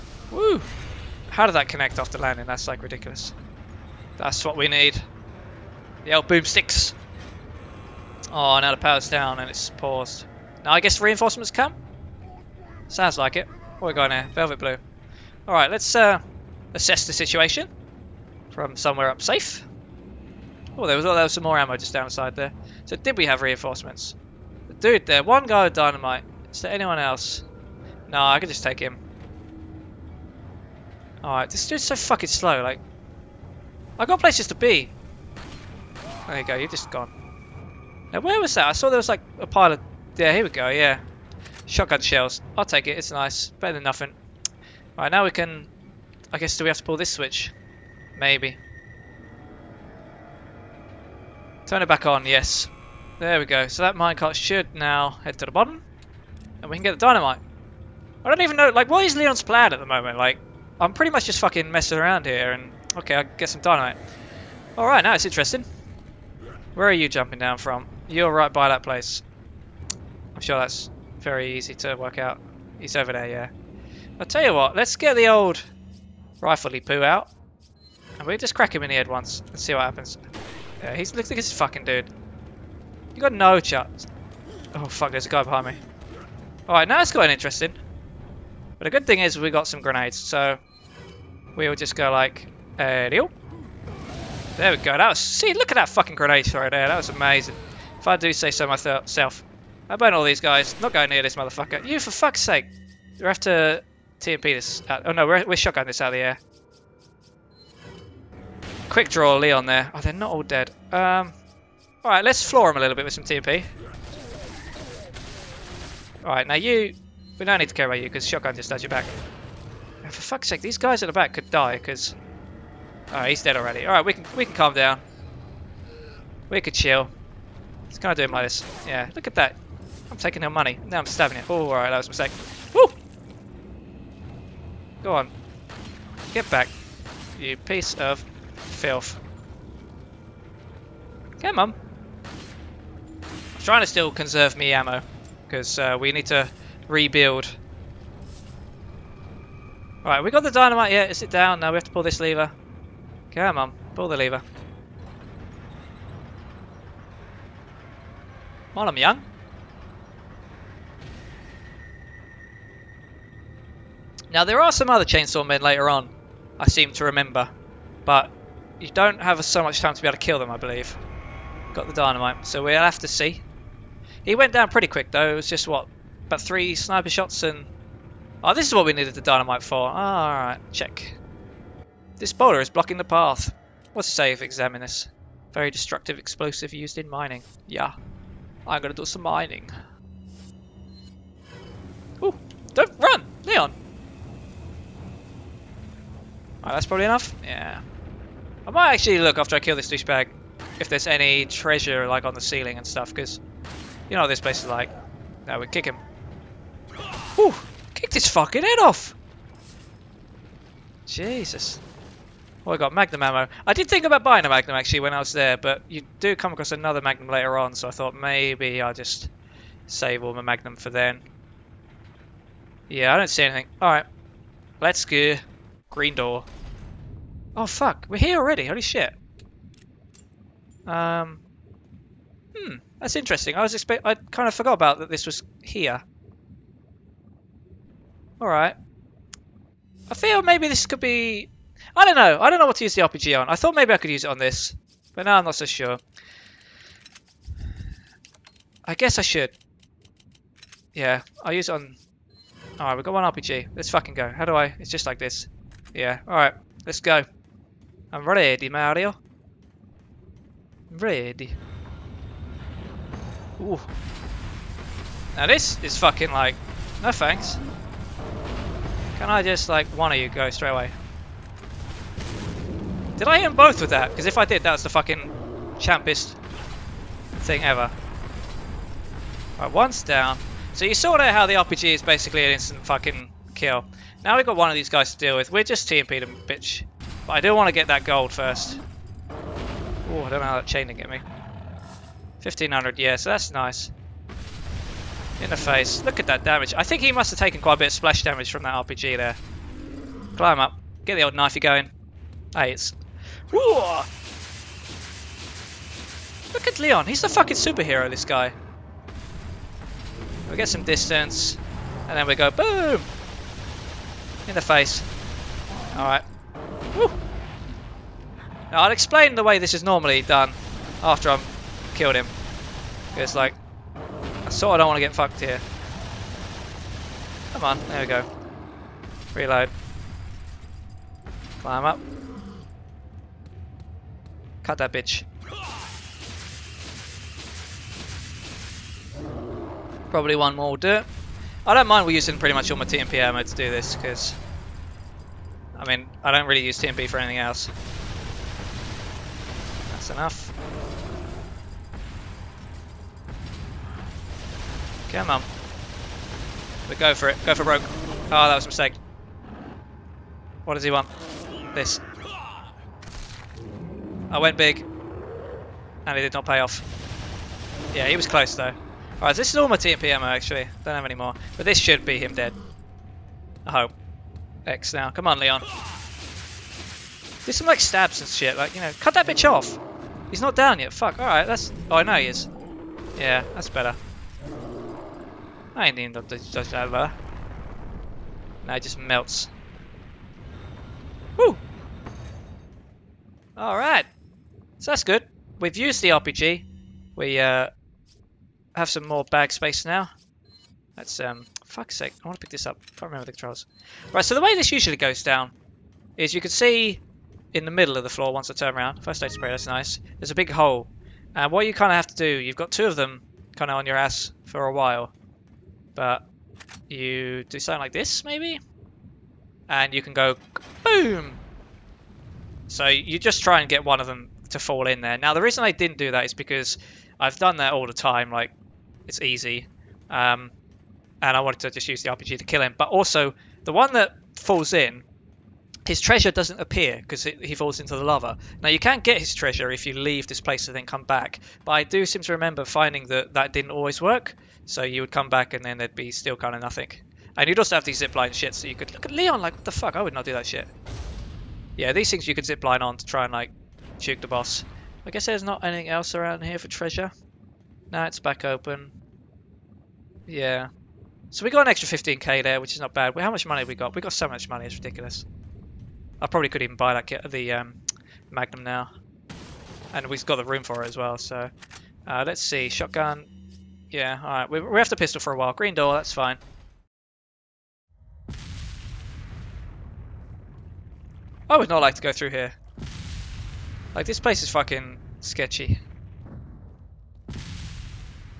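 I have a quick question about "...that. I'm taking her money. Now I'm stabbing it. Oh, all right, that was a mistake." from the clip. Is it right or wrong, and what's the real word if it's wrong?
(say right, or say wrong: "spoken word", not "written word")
right.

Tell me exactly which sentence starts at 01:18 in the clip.
And we just crack him in the head once and see what happens.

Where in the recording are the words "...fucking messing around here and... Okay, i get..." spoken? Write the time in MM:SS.
01:01.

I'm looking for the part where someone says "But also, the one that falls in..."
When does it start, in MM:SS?
07:12.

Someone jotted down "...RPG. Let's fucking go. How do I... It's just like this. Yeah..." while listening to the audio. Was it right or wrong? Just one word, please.
right.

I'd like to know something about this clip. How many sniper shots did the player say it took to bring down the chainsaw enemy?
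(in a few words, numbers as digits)
3.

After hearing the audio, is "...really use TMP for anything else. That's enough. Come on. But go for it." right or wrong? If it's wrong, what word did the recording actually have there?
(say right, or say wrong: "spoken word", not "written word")
right.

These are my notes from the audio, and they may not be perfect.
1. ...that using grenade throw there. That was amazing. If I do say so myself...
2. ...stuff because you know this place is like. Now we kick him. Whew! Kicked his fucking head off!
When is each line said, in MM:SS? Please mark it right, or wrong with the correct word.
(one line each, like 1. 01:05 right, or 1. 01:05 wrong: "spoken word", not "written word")
1. 01:35 wrong: "fucking", not "using"
2. 03:22 right.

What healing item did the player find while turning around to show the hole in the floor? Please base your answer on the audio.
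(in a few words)
First aid spray.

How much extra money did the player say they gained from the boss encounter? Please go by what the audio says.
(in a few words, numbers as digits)
15k.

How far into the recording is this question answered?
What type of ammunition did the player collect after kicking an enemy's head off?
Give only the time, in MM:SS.
03:32.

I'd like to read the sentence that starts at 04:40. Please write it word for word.
So you saw there how the RPG is basically an instant fucking kill.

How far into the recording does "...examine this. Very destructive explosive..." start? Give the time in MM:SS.
03:04.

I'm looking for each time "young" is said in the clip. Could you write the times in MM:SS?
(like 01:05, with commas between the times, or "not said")
02:38.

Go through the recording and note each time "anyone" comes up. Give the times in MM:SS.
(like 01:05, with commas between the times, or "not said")
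00:26.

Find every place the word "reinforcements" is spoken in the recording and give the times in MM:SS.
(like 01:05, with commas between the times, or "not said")
00:11, 00:23.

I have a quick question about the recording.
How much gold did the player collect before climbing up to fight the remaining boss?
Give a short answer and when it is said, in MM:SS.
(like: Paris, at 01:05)
1500, at 04:52.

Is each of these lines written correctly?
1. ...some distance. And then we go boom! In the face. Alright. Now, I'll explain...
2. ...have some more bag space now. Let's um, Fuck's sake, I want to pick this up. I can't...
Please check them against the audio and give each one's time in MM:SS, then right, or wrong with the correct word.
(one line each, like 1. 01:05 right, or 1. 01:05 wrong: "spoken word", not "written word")
1. 05:10 right
2. 06:38 right.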